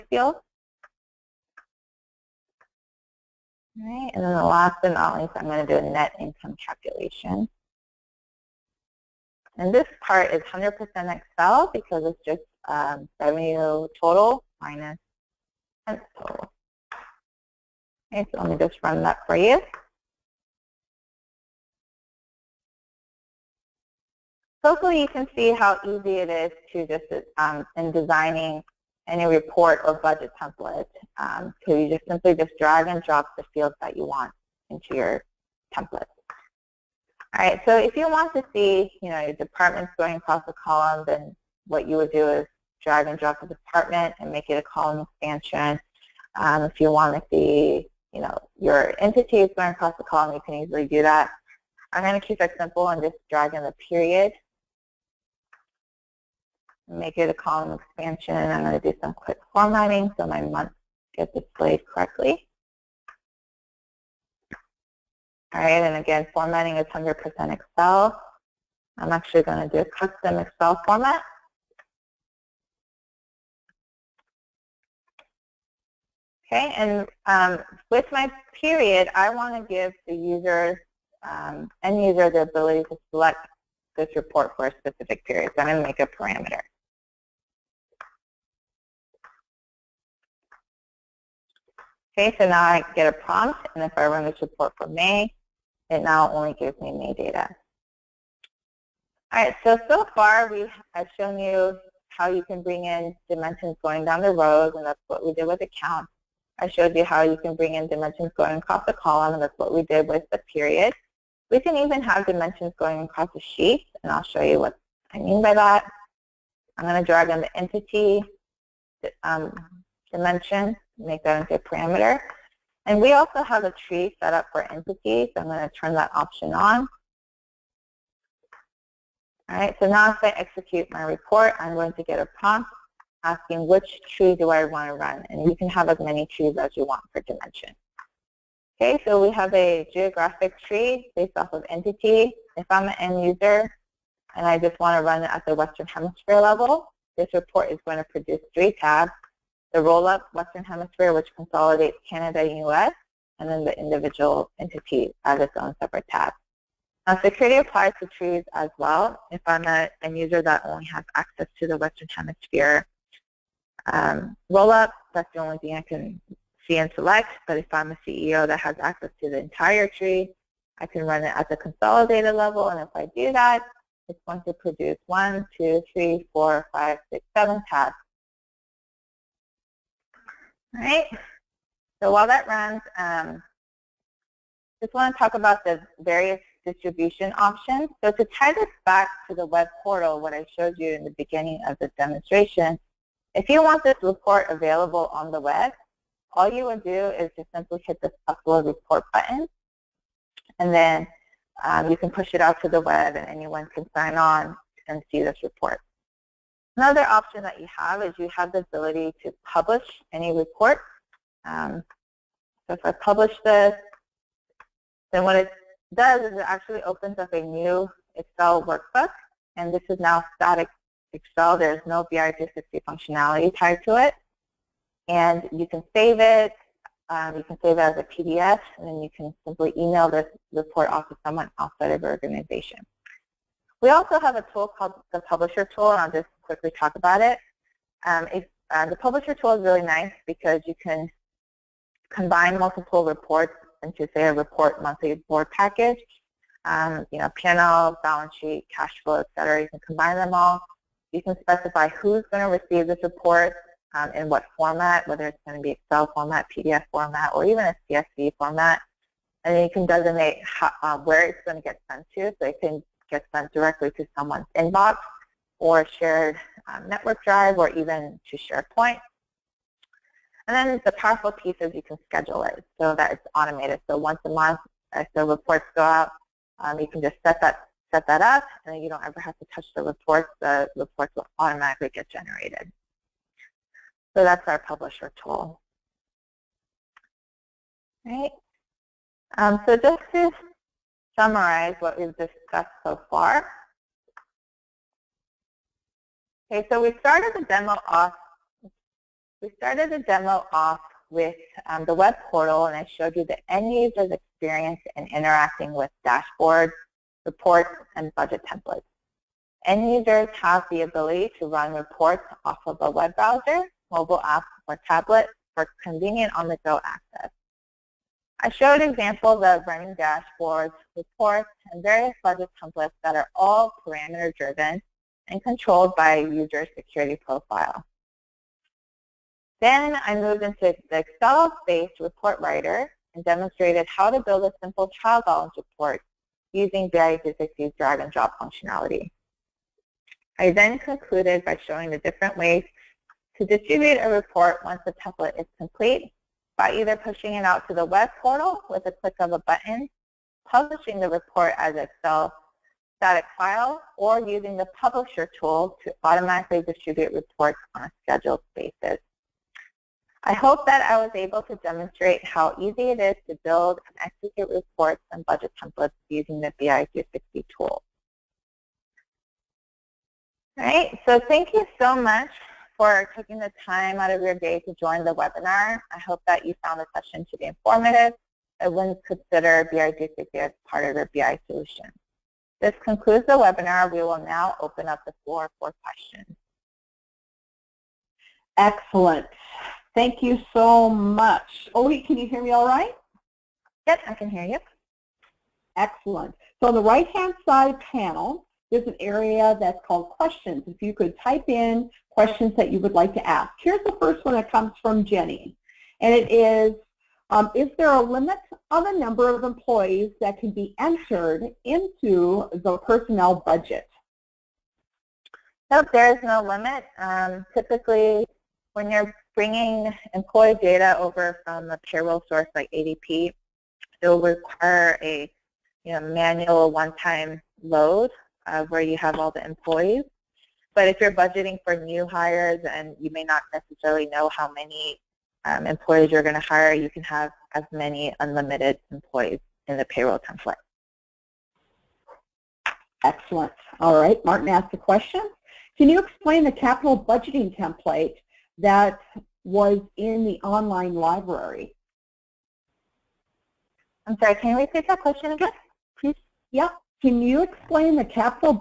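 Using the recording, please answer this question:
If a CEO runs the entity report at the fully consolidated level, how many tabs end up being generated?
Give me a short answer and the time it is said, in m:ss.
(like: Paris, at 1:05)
7, at 2:57.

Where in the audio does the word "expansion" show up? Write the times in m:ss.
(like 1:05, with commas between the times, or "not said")
0:45, 0:57.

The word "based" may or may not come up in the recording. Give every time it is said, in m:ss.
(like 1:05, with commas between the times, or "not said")
2:21, 5:30.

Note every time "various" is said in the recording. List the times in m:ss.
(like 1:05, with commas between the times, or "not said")
3:05, 5:21.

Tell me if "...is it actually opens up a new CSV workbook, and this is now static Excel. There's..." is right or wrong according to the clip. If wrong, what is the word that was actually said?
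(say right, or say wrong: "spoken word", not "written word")
wrong: "Excel", not "CSV".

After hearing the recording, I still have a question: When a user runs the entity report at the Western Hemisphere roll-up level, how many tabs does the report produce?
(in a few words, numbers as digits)
3.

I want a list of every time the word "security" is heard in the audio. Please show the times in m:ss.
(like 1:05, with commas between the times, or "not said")
2:37, 5:26.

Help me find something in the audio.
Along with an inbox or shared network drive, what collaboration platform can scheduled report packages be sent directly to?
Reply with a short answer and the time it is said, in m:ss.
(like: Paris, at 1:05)
SharePoint, at 4:28.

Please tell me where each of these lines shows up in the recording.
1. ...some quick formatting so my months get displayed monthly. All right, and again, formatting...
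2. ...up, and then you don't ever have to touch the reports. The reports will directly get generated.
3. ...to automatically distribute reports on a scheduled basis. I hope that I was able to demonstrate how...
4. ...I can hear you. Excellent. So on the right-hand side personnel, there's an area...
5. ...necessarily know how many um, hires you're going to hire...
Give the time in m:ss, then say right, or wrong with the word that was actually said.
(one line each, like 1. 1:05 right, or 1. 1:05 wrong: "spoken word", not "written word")
1. 0:59 wrong: "correctly", not "monthly"
2. 4:38 wrong: "automatically", not "directly"
3. 5:55 right
4. 6:34 wrong: "panel", not "personnel"
5. 7:13 wrong: "employees", not "hires".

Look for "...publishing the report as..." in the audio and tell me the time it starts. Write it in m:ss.
5:50.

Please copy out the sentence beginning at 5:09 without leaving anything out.
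End users have the ability to run reports off of a web browser, mobile app, or tablet for convenient on-the-go access.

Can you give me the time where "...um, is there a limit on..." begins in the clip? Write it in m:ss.
6:47.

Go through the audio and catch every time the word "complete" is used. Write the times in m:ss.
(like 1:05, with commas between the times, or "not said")
5:45.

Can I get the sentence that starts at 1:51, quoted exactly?
We can even have dimensions going across the sheet, and I'll show you what I mean by that.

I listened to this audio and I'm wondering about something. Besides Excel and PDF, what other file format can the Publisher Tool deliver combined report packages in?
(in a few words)
CSV.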